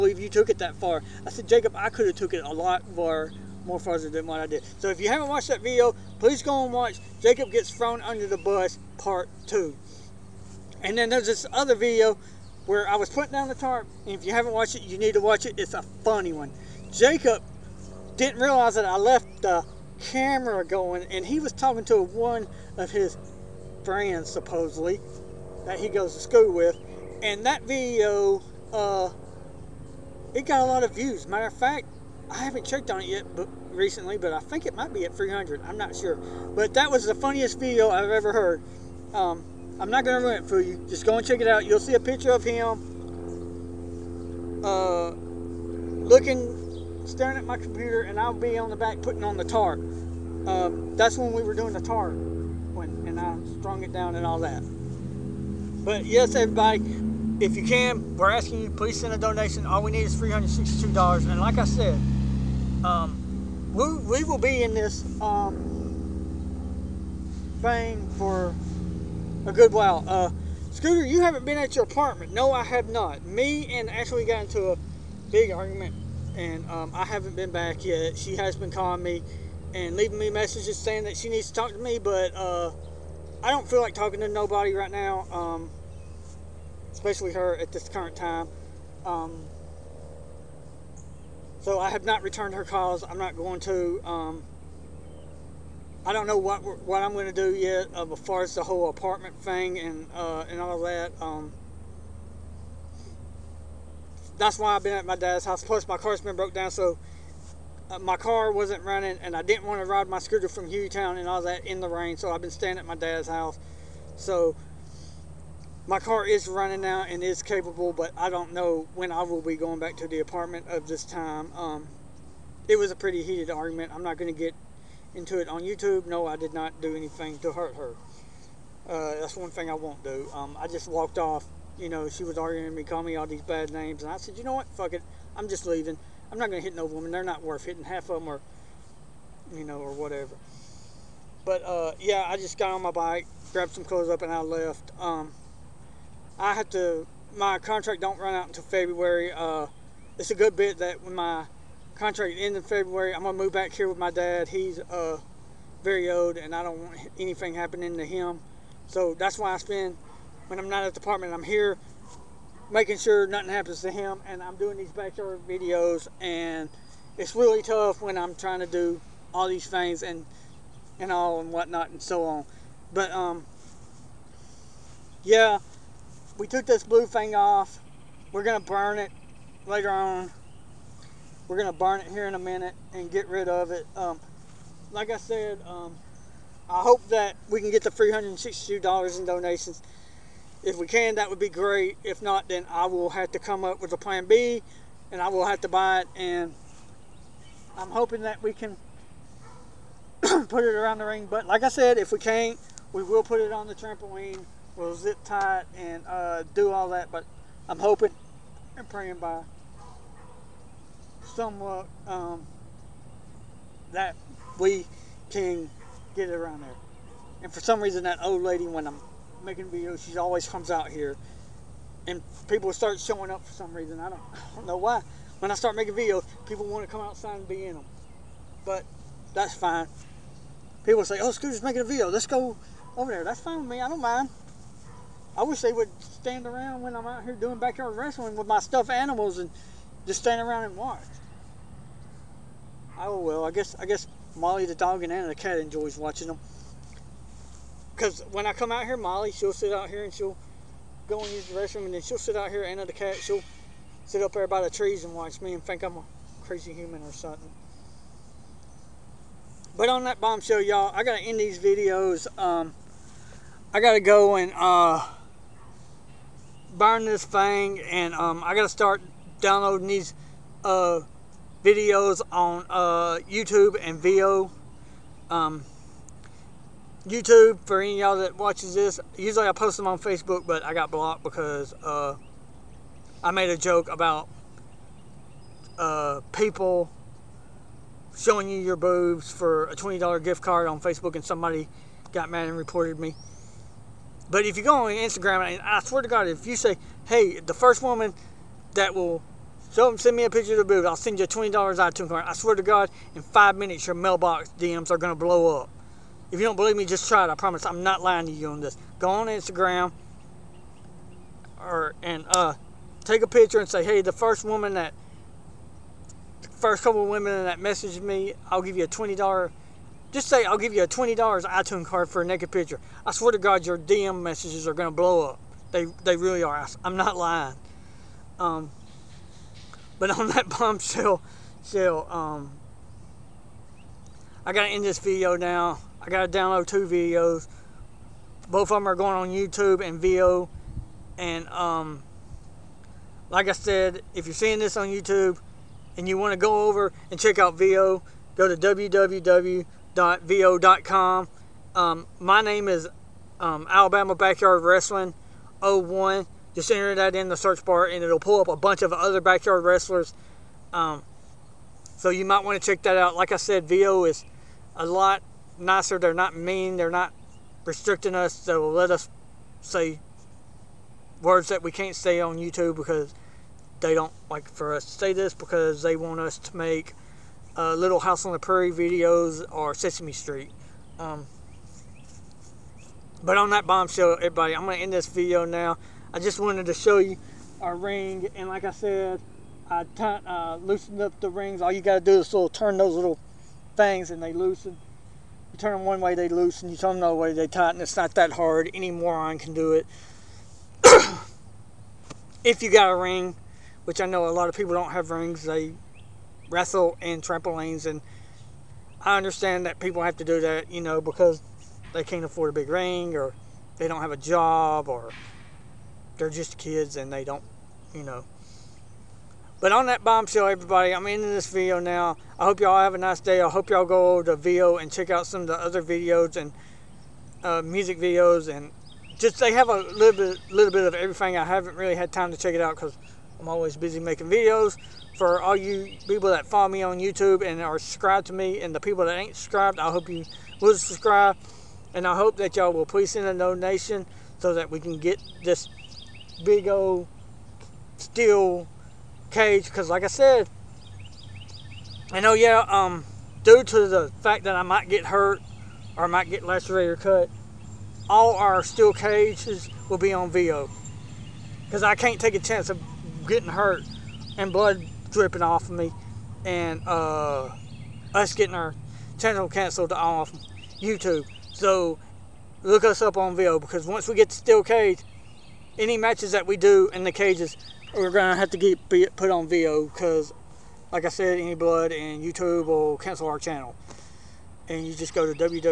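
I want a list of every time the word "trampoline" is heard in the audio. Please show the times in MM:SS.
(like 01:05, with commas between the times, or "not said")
03:23, 06:47.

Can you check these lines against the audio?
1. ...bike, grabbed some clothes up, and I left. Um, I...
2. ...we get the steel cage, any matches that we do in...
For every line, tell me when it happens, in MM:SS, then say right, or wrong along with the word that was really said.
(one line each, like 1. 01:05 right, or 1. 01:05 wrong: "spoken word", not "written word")
1. 02:22 right
2. 07:54 right.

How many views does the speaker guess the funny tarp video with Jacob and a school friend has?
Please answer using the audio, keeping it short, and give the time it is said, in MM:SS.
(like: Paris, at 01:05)
300, at 00:35.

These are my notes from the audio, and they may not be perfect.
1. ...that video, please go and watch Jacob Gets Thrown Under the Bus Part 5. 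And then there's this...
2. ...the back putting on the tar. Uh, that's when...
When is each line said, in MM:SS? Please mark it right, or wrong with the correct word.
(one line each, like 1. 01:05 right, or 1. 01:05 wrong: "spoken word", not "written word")
1. 00:05 wrong: "2", not "5"
2. 00:48 right.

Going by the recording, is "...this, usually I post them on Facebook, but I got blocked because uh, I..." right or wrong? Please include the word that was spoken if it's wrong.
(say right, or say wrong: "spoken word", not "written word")
right.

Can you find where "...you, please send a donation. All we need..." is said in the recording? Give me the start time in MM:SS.
00:58.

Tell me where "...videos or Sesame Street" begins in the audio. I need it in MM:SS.
06:18.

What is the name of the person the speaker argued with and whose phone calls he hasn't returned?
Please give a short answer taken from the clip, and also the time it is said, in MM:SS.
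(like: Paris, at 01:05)
Ashley, at 01:13.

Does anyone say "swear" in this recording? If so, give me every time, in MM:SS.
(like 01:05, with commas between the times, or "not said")
04:55, 05:02, 05:23.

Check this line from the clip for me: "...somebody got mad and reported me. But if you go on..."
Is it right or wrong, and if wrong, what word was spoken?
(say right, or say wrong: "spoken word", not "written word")
right.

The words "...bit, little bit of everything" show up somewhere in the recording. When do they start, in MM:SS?
07:10.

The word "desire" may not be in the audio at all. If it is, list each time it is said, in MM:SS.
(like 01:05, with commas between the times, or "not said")
not said.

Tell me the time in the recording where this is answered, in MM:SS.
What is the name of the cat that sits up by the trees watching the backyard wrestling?
04:05.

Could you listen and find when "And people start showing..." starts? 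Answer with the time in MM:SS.
03:42.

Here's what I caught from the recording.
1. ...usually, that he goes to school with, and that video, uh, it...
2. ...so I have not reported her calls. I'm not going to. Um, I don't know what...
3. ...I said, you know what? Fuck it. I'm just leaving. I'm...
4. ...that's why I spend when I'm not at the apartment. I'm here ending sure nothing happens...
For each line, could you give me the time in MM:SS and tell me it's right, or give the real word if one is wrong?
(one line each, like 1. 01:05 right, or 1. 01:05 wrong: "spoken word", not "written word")
1. 00:24 wrong: "supposedly", not "usually"
2. 01:31 wrong: "returned", not "reported"
3. 02:14 right
4. 02:39 wrong: "making", not "ending".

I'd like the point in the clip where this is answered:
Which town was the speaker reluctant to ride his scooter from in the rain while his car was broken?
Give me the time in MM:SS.
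01:50.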